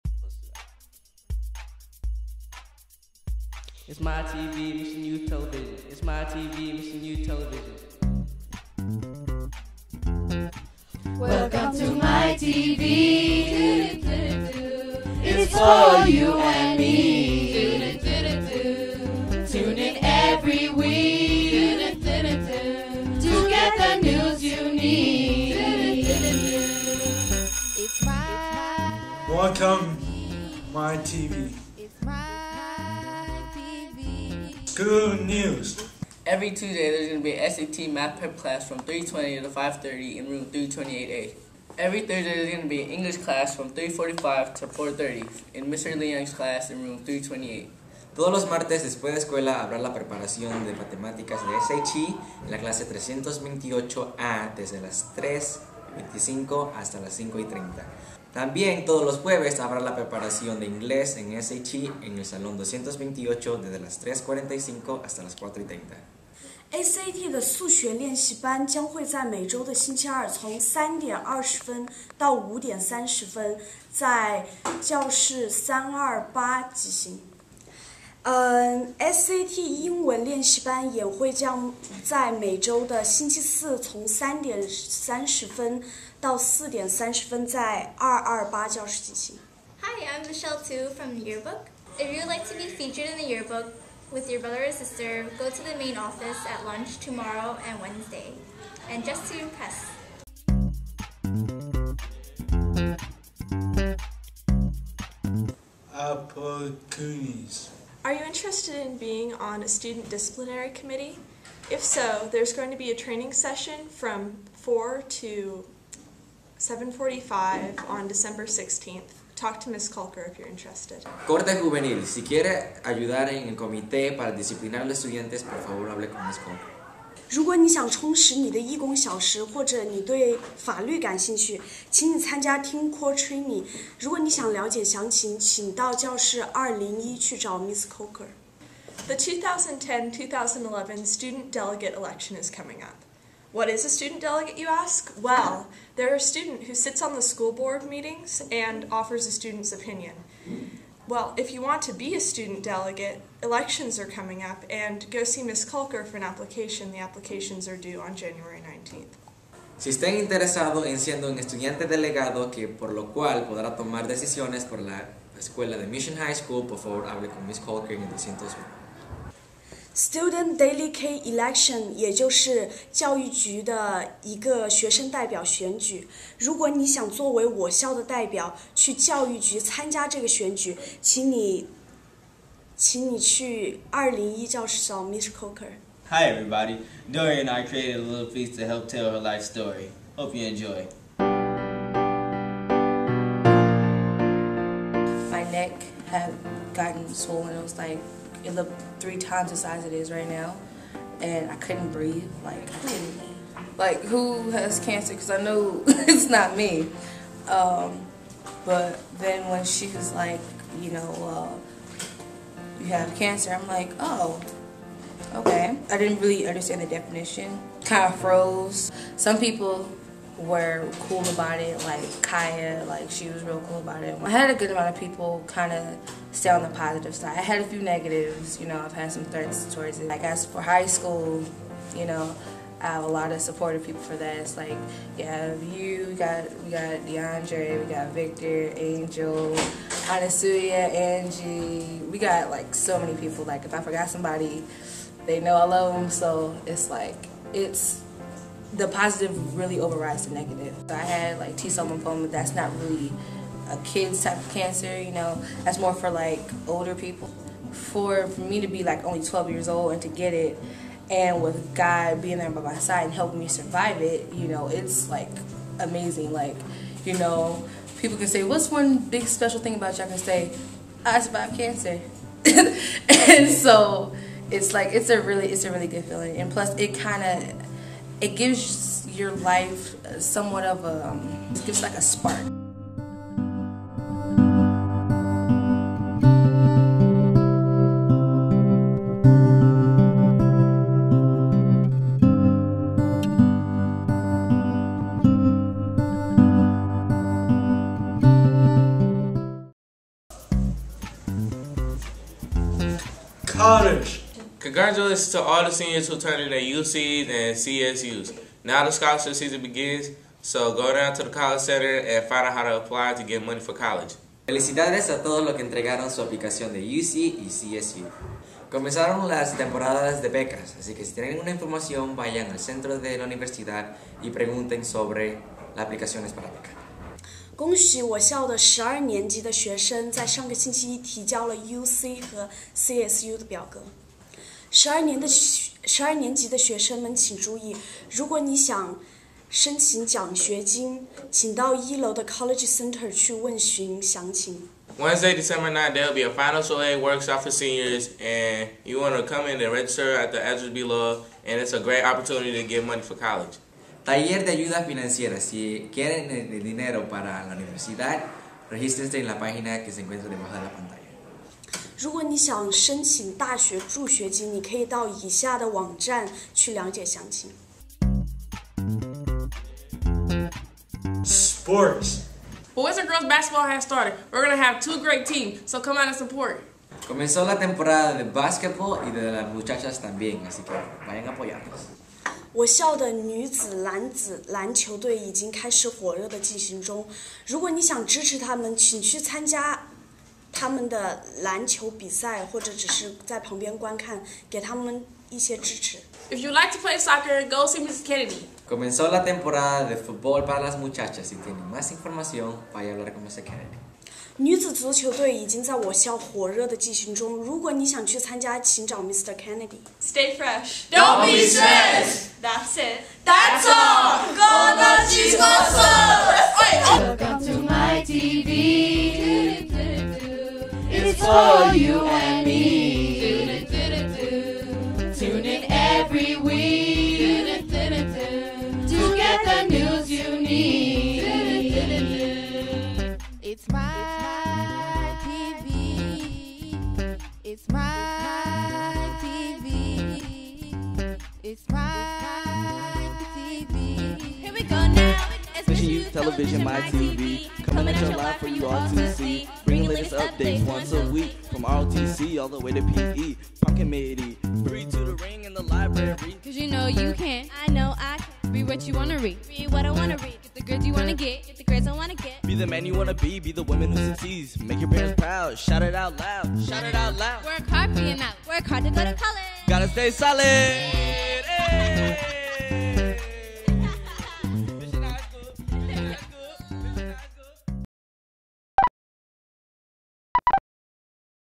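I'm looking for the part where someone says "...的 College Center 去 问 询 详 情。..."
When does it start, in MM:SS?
05:42.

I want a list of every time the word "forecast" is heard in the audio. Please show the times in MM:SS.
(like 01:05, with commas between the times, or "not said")
not said.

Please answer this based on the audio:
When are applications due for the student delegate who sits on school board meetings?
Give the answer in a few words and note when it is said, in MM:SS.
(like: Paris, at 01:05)
January 19, at 02:38.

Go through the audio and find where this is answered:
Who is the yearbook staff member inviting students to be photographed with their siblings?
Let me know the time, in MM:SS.
01:30.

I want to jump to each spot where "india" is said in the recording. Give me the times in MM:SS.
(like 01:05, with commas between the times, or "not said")
not said.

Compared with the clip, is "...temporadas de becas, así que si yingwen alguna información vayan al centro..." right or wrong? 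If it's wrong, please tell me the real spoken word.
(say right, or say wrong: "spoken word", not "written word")
wrong: "tienen", not "yingwen".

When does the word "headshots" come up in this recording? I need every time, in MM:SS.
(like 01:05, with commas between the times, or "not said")
not said.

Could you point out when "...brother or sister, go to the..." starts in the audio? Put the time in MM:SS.
01:34.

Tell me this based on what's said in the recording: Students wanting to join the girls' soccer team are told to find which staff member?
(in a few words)
Mr. Kennedy.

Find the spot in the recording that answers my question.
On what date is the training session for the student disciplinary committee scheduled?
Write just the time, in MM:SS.
01:58.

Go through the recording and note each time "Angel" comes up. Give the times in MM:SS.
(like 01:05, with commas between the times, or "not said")
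03:58.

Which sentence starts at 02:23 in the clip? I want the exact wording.
What is a student delegate, you ask?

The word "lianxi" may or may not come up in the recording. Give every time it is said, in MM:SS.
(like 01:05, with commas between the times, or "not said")
01:07, 01:20.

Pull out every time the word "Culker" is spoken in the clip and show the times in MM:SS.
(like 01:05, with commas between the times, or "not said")
01:59, 02:06, 02:35, 02:47.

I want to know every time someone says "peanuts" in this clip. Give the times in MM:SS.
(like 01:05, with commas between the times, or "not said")
not said.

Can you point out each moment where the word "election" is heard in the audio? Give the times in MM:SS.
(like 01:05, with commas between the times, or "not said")
02:21, 02:33, 02:51.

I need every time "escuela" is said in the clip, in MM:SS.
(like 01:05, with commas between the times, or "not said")
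00:49, 02:45.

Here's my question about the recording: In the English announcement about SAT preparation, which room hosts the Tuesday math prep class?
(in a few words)
328A.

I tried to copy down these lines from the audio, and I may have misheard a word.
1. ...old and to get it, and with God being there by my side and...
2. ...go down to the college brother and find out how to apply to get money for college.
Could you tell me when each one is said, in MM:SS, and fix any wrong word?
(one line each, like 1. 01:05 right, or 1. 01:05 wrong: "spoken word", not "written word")
1. 04:19 right
2. 05:10 wrong: "center", not "brother".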